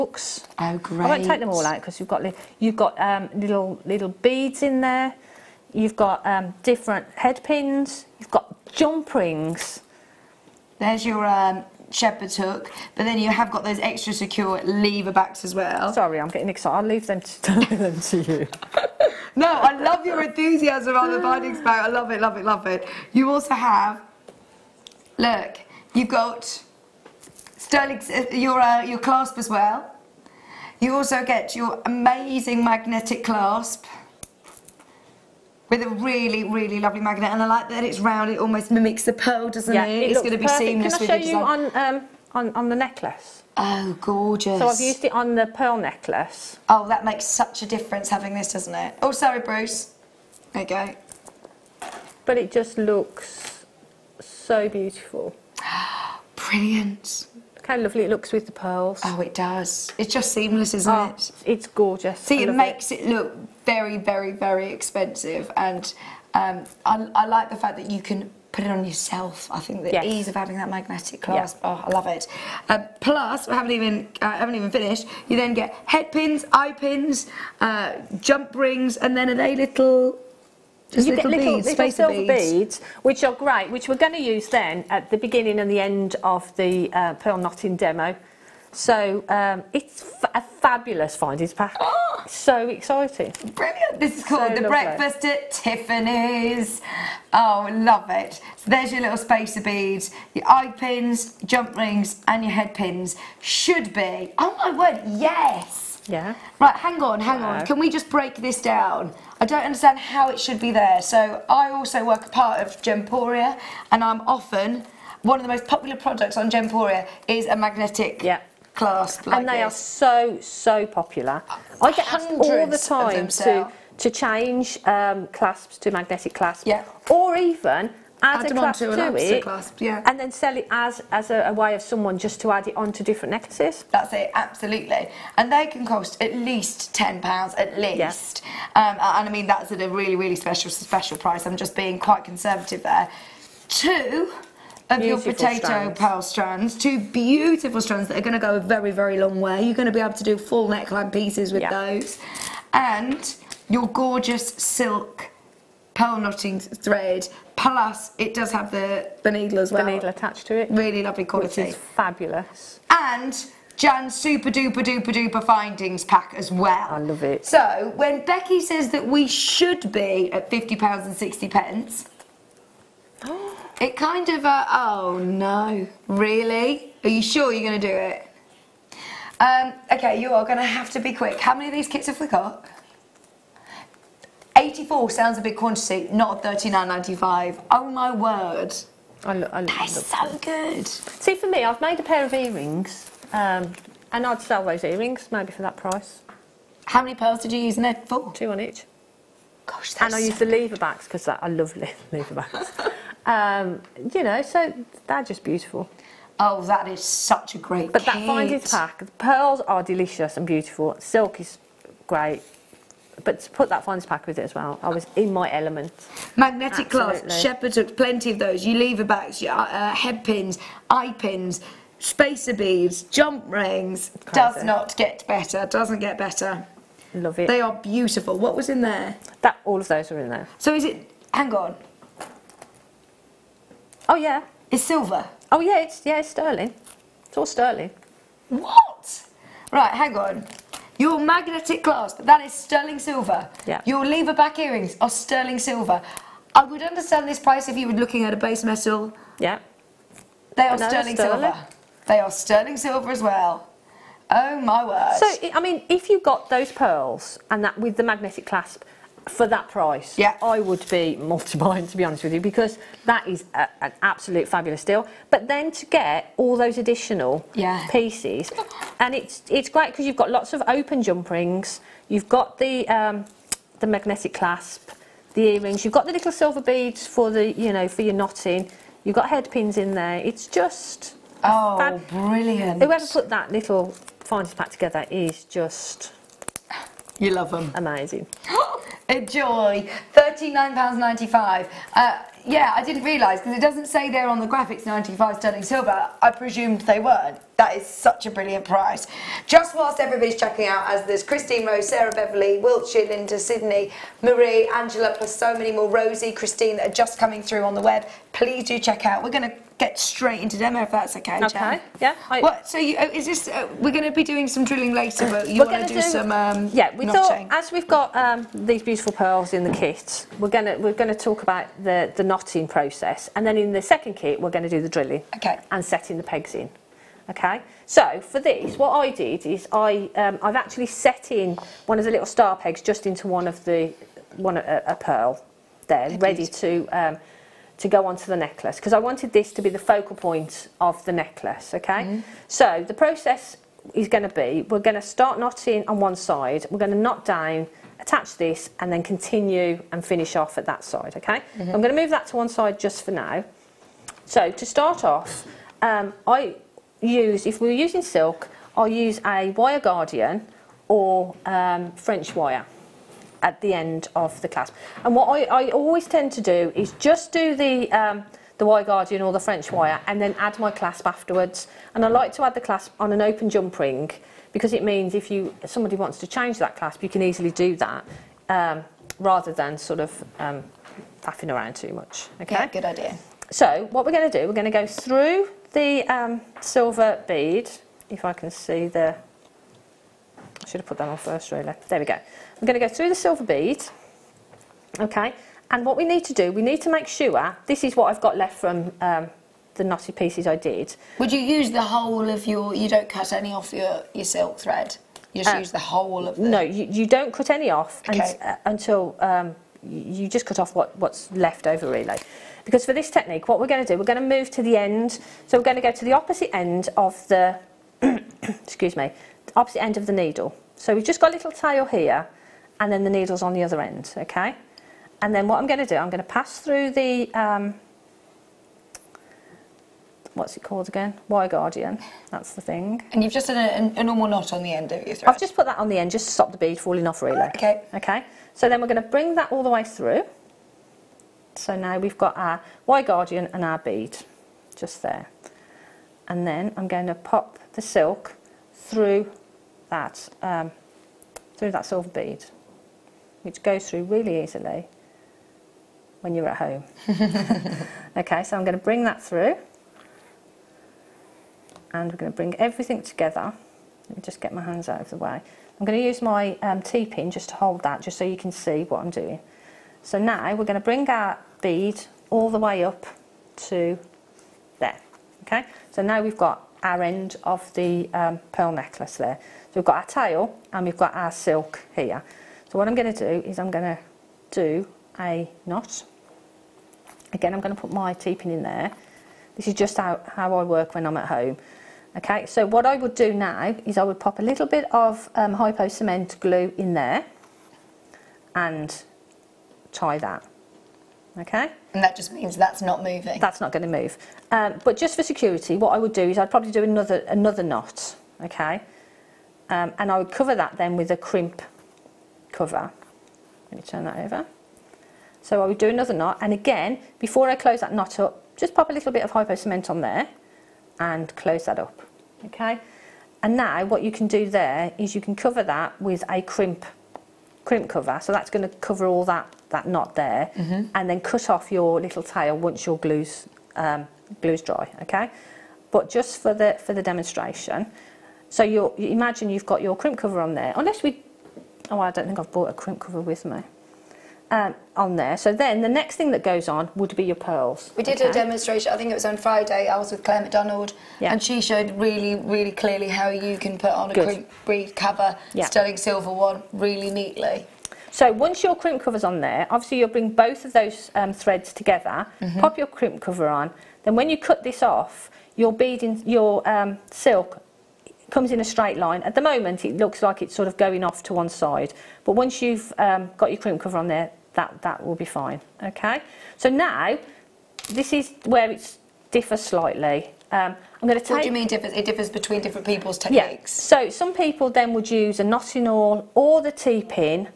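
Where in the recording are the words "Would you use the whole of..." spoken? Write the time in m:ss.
6:41.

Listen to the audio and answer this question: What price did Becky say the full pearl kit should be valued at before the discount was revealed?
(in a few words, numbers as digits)
£50.60.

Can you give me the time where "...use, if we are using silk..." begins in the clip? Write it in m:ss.
5:57.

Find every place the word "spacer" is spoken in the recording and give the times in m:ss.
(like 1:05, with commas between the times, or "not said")
1:39, 3:41.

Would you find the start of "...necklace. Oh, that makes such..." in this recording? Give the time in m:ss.
0:45.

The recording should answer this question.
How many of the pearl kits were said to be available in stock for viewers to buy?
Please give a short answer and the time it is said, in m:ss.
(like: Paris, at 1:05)
84, at 3:04.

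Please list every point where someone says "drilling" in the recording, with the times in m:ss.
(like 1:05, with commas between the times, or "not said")
5:14, 5:24.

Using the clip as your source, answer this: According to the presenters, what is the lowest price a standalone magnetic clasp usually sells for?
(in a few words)
10 pounds.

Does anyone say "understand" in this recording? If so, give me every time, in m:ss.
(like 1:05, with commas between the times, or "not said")
1:49, 4:06.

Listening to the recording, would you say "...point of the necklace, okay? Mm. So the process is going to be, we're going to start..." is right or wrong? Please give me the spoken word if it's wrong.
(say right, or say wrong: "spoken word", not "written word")
right.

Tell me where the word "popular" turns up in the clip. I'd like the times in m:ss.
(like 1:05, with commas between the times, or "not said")
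1:55, 2:00.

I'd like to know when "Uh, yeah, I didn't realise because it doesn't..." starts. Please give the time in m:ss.
4:51.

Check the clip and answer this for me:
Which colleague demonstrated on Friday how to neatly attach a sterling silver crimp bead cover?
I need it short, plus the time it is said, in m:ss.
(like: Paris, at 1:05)
Claire McDonald, at 9:10.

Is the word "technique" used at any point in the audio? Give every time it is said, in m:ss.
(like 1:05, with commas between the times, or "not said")
6:53, 9:43.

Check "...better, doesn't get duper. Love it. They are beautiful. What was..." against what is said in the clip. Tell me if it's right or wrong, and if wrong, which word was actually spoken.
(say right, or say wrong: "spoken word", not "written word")
wrong: "better", not "duper".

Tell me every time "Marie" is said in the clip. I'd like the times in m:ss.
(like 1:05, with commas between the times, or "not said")
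5:04.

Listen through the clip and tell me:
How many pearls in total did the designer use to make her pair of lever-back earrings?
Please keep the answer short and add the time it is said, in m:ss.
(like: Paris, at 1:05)
4, at 3:18.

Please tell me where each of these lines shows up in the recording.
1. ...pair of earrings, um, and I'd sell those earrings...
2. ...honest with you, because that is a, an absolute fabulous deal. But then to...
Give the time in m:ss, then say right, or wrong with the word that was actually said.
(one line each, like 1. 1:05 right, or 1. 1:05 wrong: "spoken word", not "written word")
1. 3:12 right
2. 4:22 right.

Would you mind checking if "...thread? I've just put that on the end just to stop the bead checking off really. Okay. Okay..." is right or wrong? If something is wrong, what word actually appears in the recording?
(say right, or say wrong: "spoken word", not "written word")
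wrong: "falling", not "checking".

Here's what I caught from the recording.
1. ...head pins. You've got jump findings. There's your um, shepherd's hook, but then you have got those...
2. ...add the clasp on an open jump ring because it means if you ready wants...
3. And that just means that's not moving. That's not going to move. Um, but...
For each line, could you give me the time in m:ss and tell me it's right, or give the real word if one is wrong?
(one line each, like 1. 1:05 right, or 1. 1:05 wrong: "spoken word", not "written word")
1. 0:07 wrong: "rings", not "findings"
2. 6:12 wrong: "somebody", not "ready"
3. 8:21 right.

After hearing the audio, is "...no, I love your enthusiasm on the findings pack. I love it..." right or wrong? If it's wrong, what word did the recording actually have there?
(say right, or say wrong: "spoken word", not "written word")
right.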